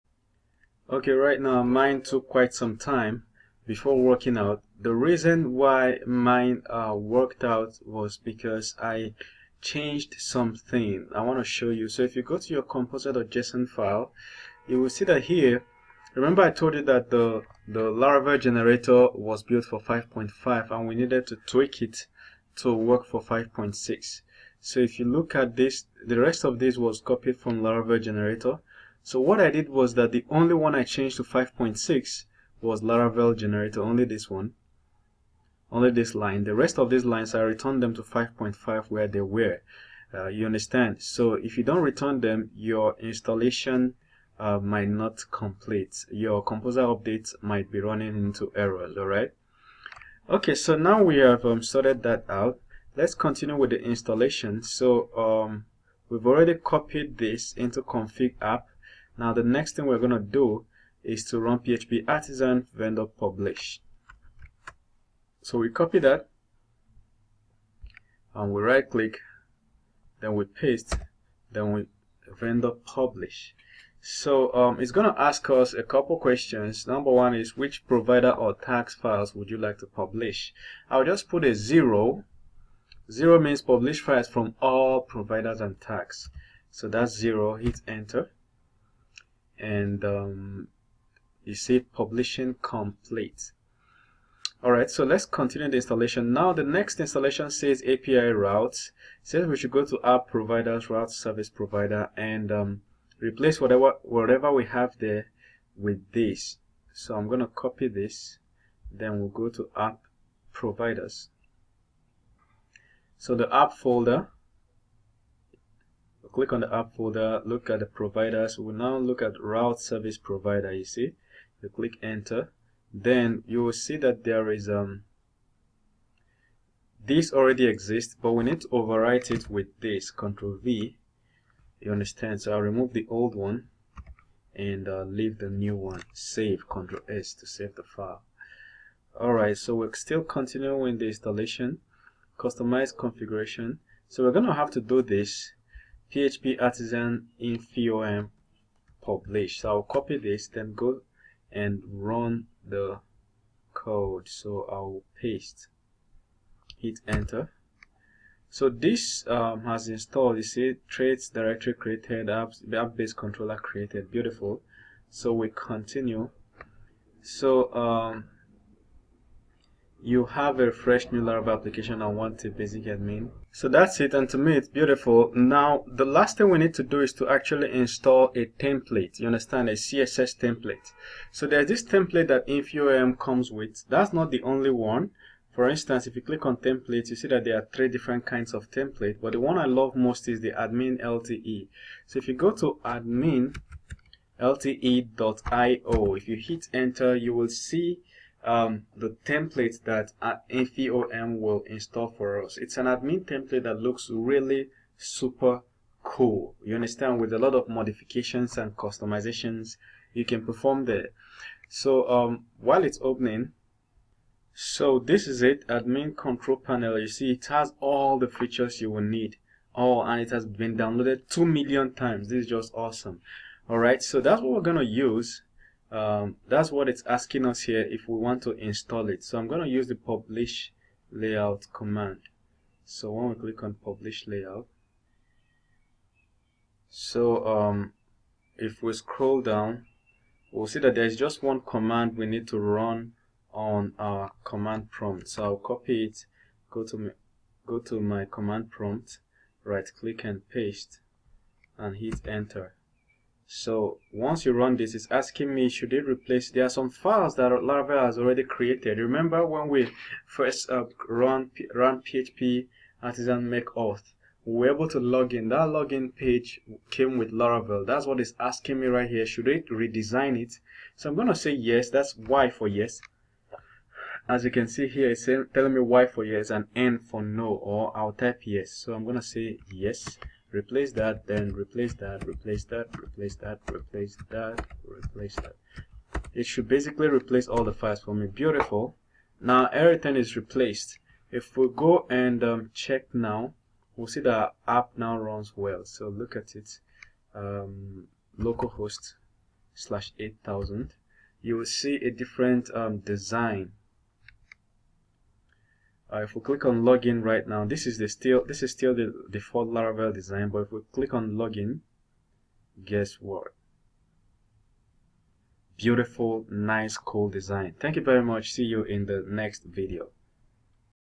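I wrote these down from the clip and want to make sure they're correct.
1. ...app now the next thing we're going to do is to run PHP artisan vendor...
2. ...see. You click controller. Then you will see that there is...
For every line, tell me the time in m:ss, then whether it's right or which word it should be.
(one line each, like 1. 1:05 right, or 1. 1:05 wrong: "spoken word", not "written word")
1. 0:58 right
2. 2:00 wrong: "enter", not "controller".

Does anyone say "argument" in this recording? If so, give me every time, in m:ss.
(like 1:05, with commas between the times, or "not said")
not said.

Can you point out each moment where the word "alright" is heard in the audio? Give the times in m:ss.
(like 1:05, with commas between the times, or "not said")
0:48, 2:19, 3:43.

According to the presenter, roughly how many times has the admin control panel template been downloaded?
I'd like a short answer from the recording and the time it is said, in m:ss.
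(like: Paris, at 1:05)
2 million, at 3:41.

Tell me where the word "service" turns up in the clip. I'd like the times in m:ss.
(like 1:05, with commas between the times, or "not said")
1:41, 1:59.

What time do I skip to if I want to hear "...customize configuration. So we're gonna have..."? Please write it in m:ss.
2:22.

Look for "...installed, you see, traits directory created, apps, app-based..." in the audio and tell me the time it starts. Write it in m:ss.
2:39.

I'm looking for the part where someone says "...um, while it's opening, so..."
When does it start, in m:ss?
3:32.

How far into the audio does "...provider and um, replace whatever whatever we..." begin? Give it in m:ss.
1:41.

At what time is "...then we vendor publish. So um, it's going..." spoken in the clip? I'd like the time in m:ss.
1:11.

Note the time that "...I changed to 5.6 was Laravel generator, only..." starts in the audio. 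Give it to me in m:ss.
0:30.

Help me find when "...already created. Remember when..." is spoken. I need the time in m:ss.
4:18.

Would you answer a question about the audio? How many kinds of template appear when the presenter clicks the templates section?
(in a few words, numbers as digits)
3.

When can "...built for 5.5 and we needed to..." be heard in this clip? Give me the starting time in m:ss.
0:19.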